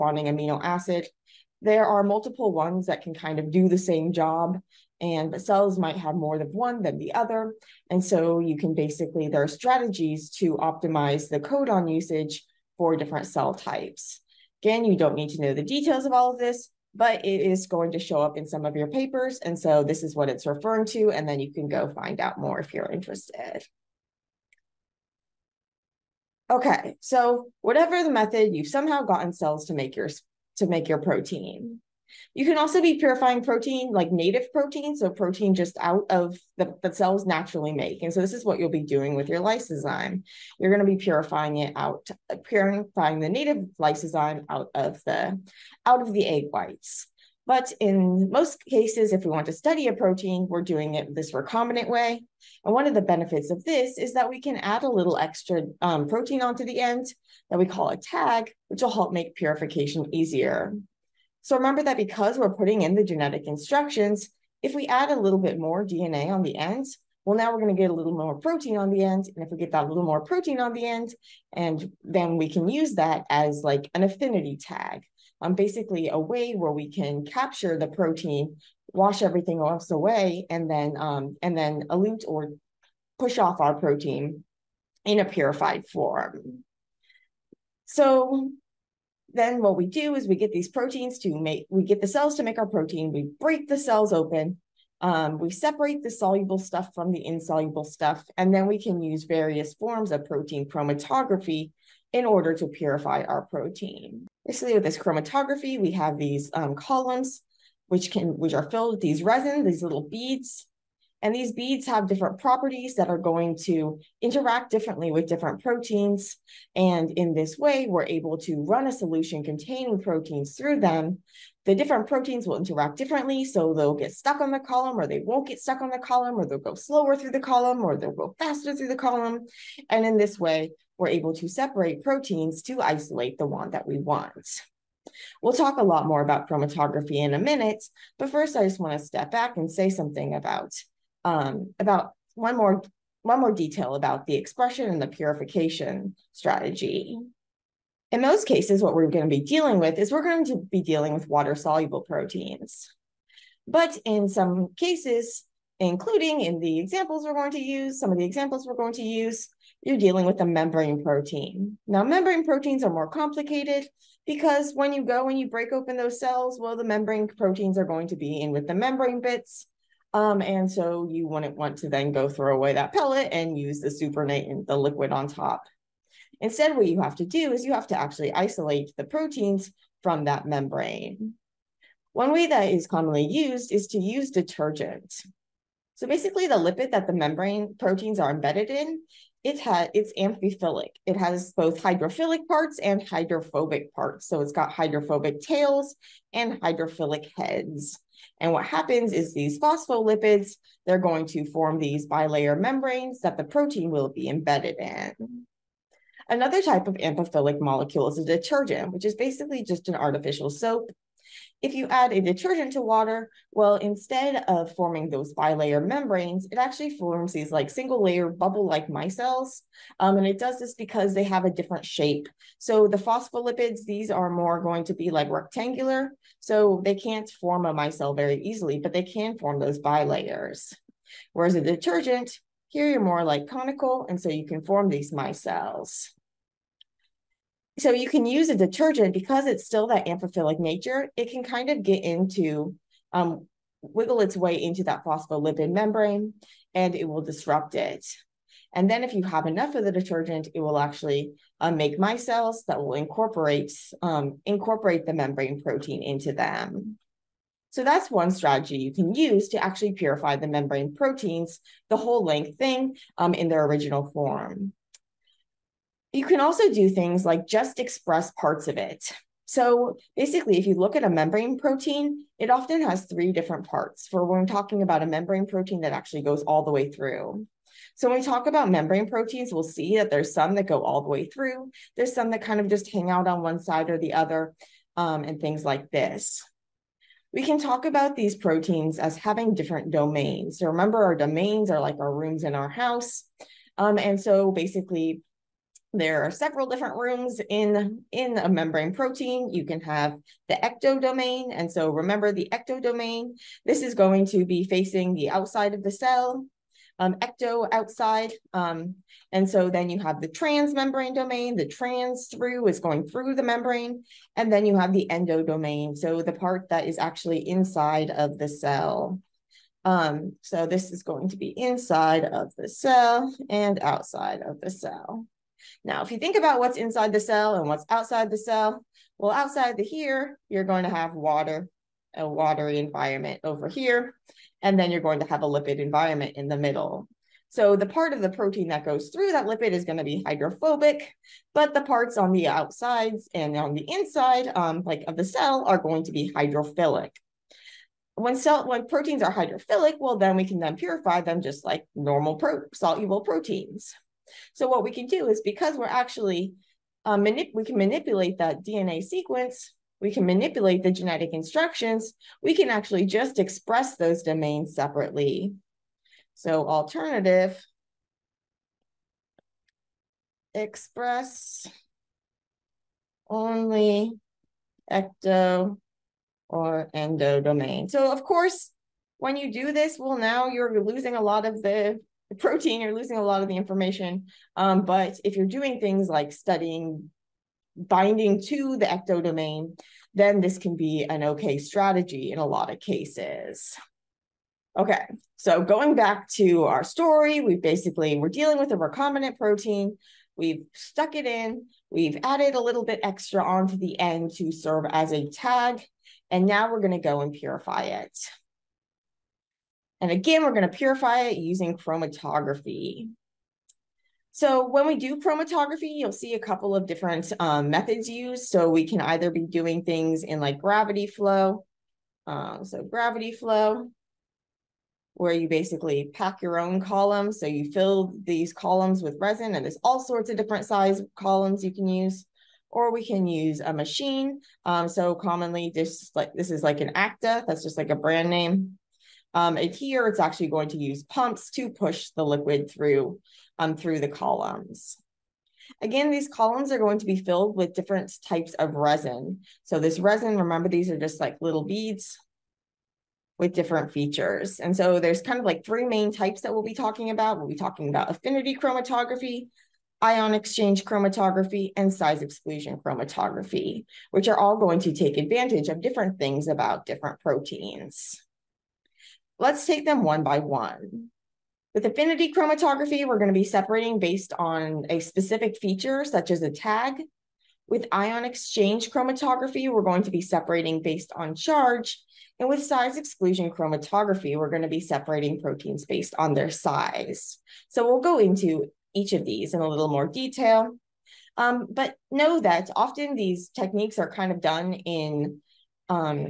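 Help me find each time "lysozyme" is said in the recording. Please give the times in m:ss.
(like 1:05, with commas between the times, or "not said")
0:39, 0:43.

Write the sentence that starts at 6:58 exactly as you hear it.
So we can either be doing things in like gravity flow.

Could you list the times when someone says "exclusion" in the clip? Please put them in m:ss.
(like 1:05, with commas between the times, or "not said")
7:42, 8:02.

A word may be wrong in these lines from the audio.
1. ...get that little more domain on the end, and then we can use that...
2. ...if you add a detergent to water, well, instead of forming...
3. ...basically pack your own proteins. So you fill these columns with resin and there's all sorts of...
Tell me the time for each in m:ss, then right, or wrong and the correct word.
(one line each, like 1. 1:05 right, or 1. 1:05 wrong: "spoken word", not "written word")
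1. 1:09 wrong: "protein", not "domain"
2. 3:31 right
3. 7:05 wrong: "columns", not "proteins".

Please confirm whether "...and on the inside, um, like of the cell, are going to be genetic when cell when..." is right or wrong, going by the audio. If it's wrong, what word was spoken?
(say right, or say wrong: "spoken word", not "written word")
wrong: "hydrophilic", not "genetic".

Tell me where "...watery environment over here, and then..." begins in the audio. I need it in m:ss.
5:32.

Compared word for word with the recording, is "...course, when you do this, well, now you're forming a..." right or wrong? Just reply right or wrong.
wrong.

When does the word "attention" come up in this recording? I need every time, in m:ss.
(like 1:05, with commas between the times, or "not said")
not said.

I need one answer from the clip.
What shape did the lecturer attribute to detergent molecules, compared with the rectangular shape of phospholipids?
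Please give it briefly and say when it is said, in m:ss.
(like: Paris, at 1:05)
Conical, at 3:53.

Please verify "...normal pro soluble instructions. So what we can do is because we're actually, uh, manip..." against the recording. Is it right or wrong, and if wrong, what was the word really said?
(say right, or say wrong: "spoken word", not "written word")
wrong: "proteins", not "instructions".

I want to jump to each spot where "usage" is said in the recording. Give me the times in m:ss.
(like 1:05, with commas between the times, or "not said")
0:11.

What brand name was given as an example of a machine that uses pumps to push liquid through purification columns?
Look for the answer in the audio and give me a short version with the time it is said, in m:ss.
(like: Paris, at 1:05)
ACTA, at 7:16.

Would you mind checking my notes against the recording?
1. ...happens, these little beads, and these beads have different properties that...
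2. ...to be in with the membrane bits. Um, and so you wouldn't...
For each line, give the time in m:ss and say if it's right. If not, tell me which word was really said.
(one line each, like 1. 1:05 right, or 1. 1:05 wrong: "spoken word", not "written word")
1. 1:49 wrong: "resins", not "happens"
2. 2:48 right.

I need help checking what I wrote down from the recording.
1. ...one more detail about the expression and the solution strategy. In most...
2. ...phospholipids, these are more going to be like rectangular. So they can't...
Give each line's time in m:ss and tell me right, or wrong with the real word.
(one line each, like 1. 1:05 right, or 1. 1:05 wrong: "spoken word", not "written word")
1. 2:23 wrong: "purification", not "solution"
2. 3:42 right.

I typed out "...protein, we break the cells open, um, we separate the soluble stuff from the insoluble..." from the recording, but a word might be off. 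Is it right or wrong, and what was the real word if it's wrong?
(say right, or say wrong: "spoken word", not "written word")
right.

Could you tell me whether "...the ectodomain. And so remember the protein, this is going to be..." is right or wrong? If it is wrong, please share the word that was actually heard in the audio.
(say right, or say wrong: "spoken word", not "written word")
wrong: "ectodomain", not "protein".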